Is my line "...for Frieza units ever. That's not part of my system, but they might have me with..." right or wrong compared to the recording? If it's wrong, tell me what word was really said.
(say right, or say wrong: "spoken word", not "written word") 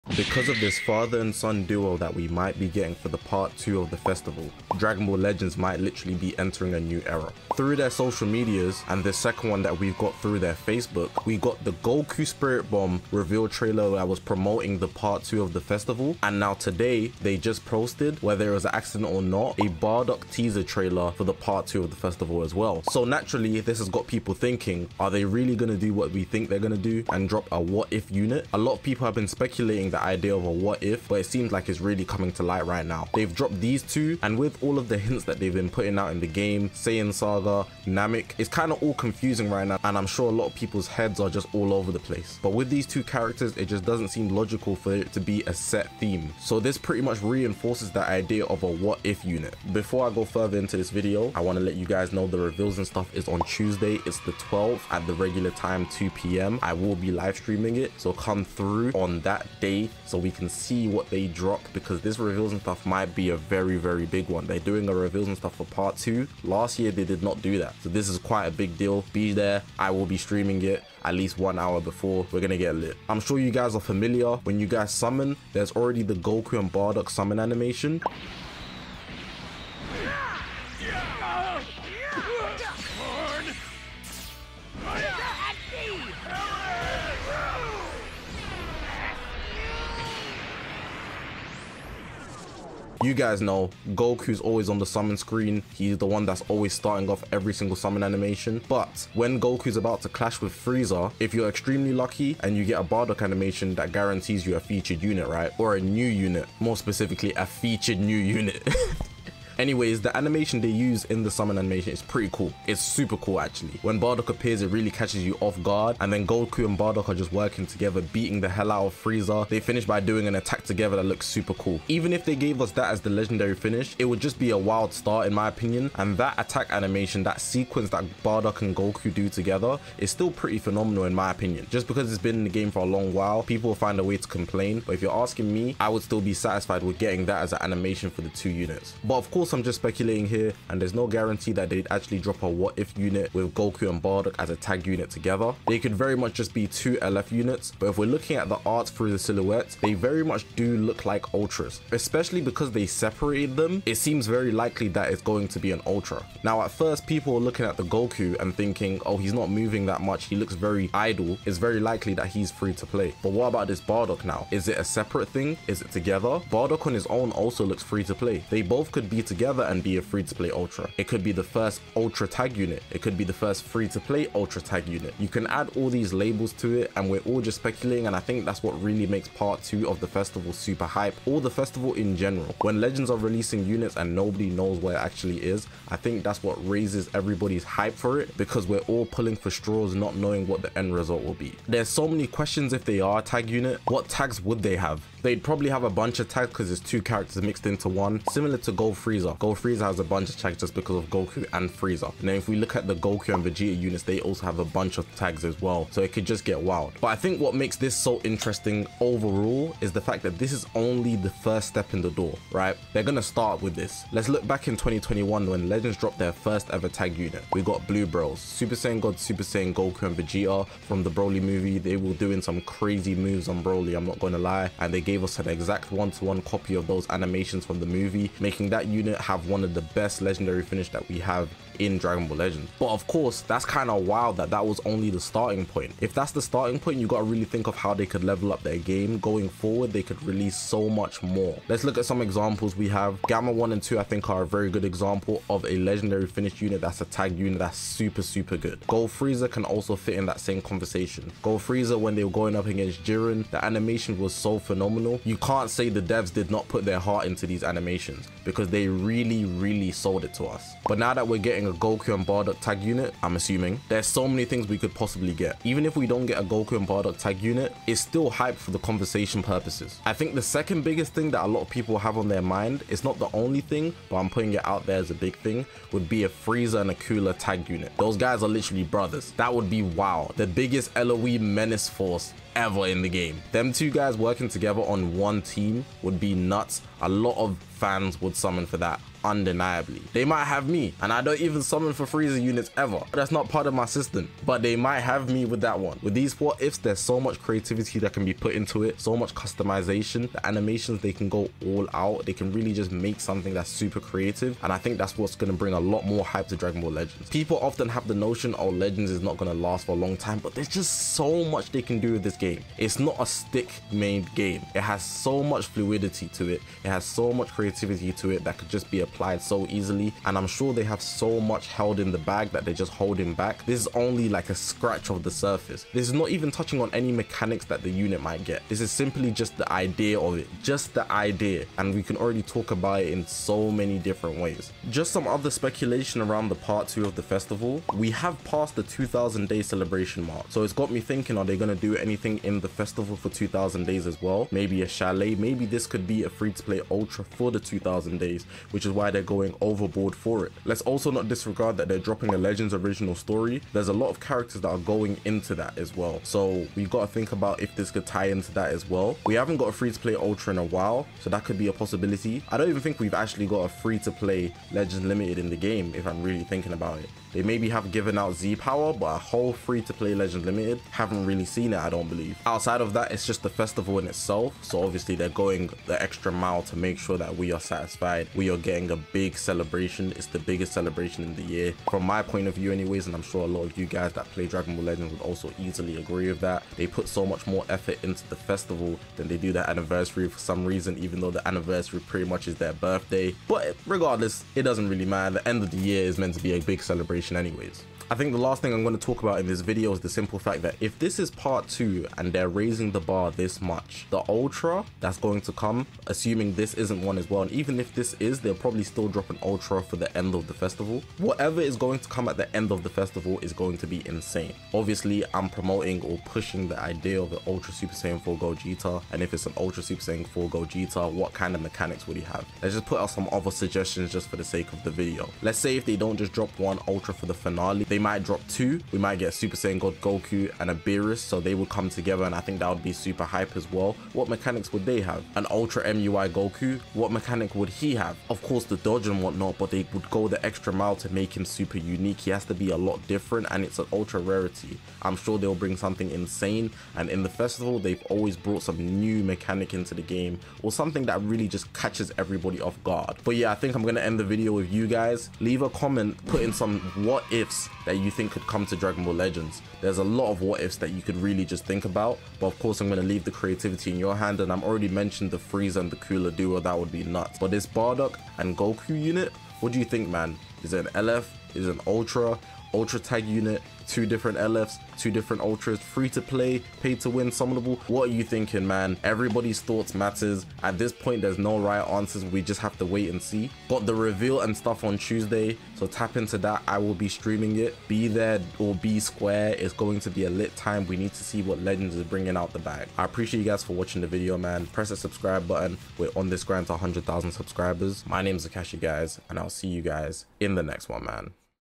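right.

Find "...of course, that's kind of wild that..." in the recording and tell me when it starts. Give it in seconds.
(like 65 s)
232 s.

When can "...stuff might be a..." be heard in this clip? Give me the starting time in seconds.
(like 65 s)
62 s.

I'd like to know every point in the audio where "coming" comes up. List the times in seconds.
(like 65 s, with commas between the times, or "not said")
32 s.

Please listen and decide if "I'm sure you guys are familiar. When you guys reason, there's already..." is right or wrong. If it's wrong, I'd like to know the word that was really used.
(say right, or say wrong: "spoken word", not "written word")
wrong: "summon", not "reason".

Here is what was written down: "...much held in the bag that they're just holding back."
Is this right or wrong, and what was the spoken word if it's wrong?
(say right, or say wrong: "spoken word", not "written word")
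right.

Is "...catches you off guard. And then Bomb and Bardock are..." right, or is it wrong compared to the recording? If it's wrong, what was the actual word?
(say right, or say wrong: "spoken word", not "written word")
wrong: "Goku", not "Bomb".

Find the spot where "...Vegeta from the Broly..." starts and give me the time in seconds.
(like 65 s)
220 s.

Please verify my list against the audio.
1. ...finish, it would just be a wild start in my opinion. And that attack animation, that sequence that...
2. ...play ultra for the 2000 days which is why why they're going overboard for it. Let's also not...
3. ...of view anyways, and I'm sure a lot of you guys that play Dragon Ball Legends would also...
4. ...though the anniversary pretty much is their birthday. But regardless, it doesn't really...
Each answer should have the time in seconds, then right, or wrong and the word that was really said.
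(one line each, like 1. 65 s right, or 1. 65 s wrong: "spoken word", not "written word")
1. 123 s right
2. 346 s right
3. 382 s right
4. 391 s right.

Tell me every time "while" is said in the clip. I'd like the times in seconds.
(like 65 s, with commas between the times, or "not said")
133 s, 360 s.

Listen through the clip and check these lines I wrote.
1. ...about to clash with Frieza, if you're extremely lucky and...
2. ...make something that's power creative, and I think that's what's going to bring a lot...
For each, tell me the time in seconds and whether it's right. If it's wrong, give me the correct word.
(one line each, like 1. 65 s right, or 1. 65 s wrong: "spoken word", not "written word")
1. 99 s right
2. 302 s wrong: "super", not "power".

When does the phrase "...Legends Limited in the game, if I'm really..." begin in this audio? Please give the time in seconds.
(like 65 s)
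364 s.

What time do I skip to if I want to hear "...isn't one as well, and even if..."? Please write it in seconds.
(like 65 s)
406 s.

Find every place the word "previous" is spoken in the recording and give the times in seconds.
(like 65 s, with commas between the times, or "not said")
not said.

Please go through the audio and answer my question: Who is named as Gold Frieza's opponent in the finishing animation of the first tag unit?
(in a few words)
Jiren.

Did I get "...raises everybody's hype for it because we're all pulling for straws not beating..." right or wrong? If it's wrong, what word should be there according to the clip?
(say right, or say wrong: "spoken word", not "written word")
wrong: "knowing", not "beating".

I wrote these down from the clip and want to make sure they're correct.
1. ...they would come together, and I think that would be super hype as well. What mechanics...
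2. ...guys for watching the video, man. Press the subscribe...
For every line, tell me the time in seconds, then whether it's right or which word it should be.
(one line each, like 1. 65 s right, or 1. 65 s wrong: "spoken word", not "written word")
1. 431 s right
2. 493 s right.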